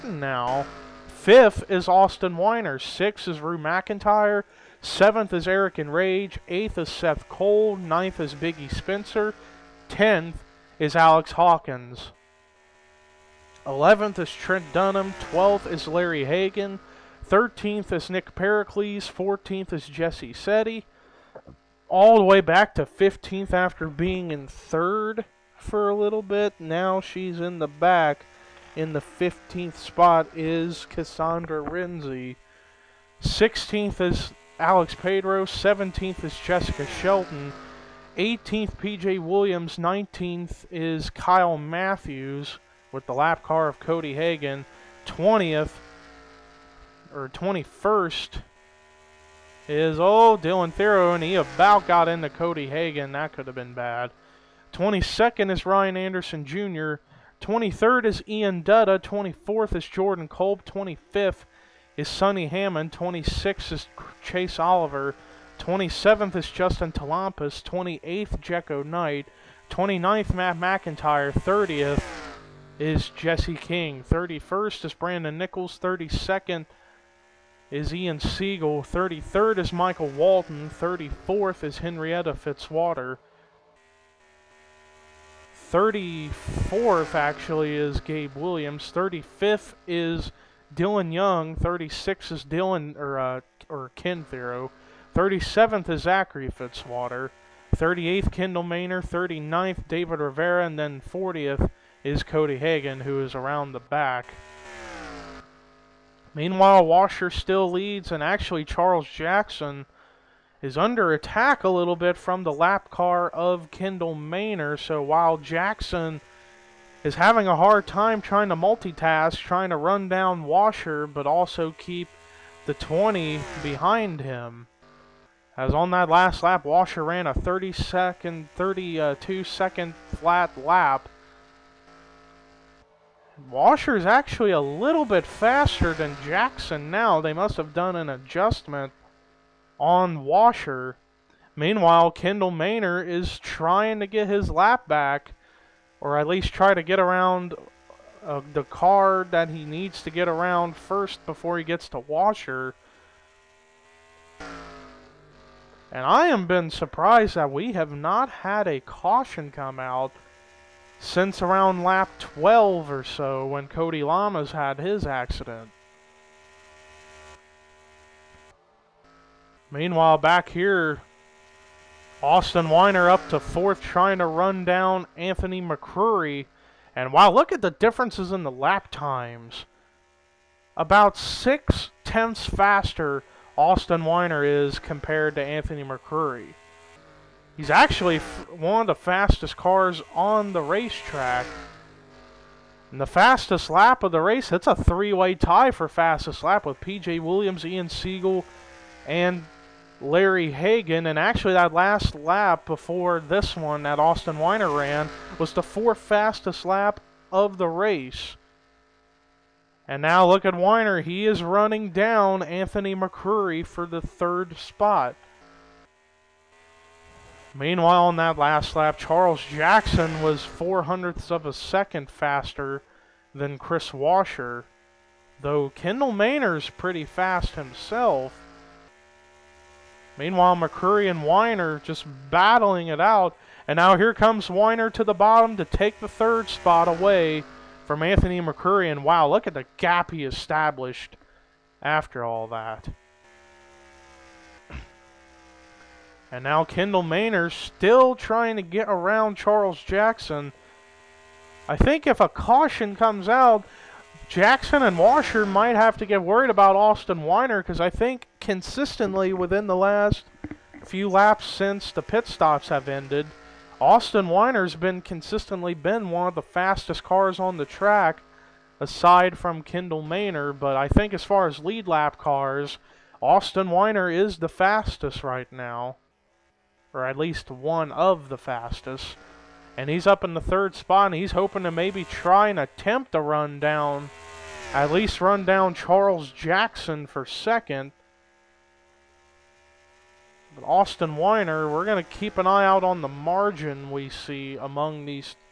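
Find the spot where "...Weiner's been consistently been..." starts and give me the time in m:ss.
4:24.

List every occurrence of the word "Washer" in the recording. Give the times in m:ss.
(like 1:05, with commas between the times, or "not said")
1:46, 2:00, 2:06, 2:13, 2:20, 2:31, 3:43, 4:14.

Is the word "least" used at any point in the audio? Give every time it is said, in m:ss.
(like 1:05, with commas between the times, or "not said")
2:26, 4:37, 4:44.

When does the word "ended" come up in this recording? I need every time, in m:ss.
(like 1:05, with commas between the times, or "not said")
4:22.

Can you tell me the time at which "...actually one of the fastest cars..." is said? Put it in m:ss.
3:07.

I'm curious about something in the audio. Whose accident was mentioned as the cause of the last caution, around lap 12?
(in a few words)
Cody Lamas.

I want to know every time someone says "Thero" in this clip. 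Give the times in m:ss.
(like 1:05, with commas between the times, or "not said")
0:50, 1:34.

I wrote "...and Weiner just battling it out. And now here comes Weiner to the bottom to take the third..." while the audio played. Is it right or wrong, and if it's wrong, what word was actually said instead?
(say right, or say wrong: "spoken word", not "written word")
right.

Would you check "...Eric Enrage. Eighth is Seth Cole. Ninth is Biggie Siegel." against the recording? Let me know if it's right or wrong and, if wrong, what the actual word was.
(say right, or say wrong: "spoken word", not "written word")
wrong: "Spencer", not "Siegel".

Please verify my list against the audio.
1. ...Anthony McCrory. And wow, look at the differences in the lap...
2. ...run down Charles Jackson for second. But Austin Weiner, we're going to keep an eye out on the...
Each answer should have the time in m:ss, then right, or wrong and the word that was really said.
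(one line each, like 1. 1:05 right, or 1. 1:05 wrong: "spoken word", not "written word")
1. 2:55 right
2. 4:45 right.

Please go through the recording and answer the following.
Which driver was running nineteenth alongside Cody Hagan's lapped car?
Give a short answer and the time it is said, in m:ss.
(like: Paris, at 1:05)
Kyle Matthews, at 0:41.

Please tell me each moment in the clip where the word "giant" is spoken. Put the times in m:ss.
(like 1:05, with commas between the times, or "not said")
not said.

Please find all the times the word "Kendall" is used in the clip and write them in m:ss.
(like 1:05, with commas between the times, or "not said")
1:38, 1:53, 2:22, 3:45, 4:06, 4:29.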